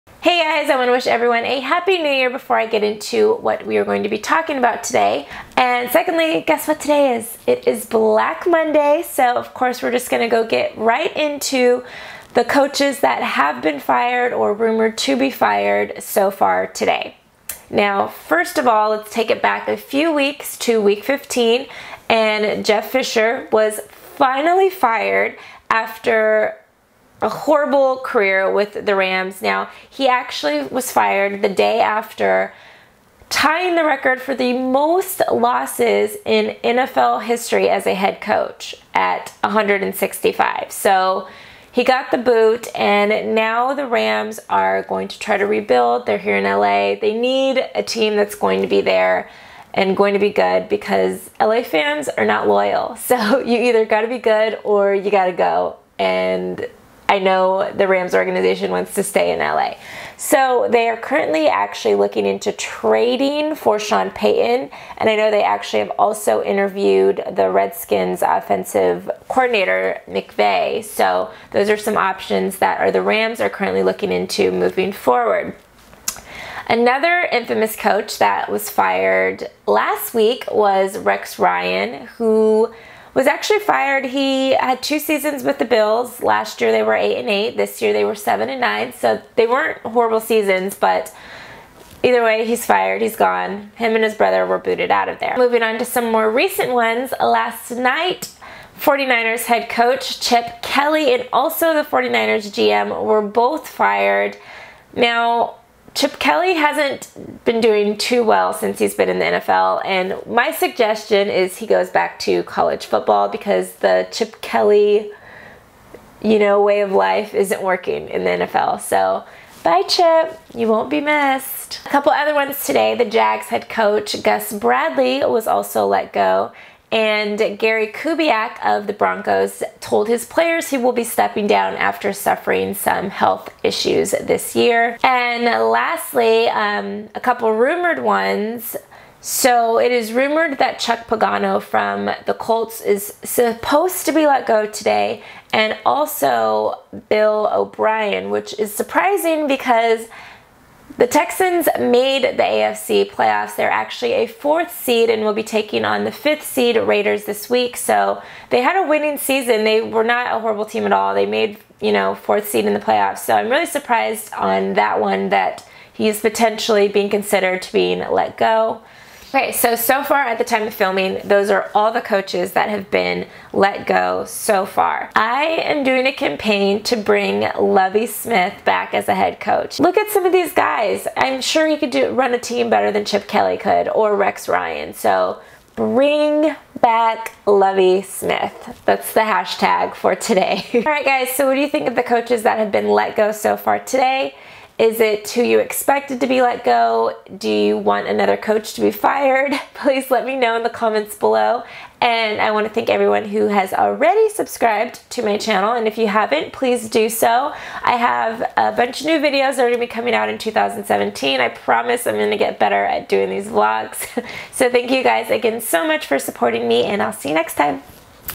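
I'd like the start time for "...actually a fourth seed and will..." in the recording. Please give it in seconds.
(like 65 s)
153 s.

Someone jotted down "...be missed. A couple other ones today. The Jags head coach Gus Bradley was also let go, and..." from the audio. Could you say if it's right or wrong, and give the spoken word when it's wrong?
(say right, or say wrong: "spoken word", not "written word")
right.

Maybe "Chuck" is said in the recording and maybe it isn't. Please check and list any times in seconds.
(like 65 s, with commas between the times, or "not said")
140 s.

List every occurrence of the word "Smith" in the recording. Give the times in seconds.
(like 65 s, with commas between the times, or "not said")
178 s, 188 s.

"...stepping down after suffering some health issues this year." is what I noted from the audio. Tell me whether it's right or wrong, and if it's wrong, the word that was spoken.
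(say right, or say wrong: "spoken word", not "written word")
right.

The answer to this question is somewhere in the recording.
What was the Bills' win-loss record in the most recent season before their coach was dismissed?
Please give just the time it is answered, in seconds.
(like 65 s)
88 s.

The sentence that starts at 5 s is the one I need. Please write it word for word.
And secondly, guess what today is?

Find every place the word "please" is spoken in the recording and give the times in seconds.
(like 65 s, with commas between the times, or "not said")
199 s, 206 s.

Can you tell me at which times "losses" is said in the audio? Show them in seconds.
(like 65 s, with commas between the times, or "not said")
35 s.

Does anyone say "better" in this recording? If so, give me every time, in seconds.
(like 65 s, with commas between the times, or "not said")
182 s, 212 s.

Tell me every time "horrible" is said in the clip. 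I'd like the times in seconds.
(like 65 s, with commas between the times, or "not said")
27 s, 89 s, 160 s.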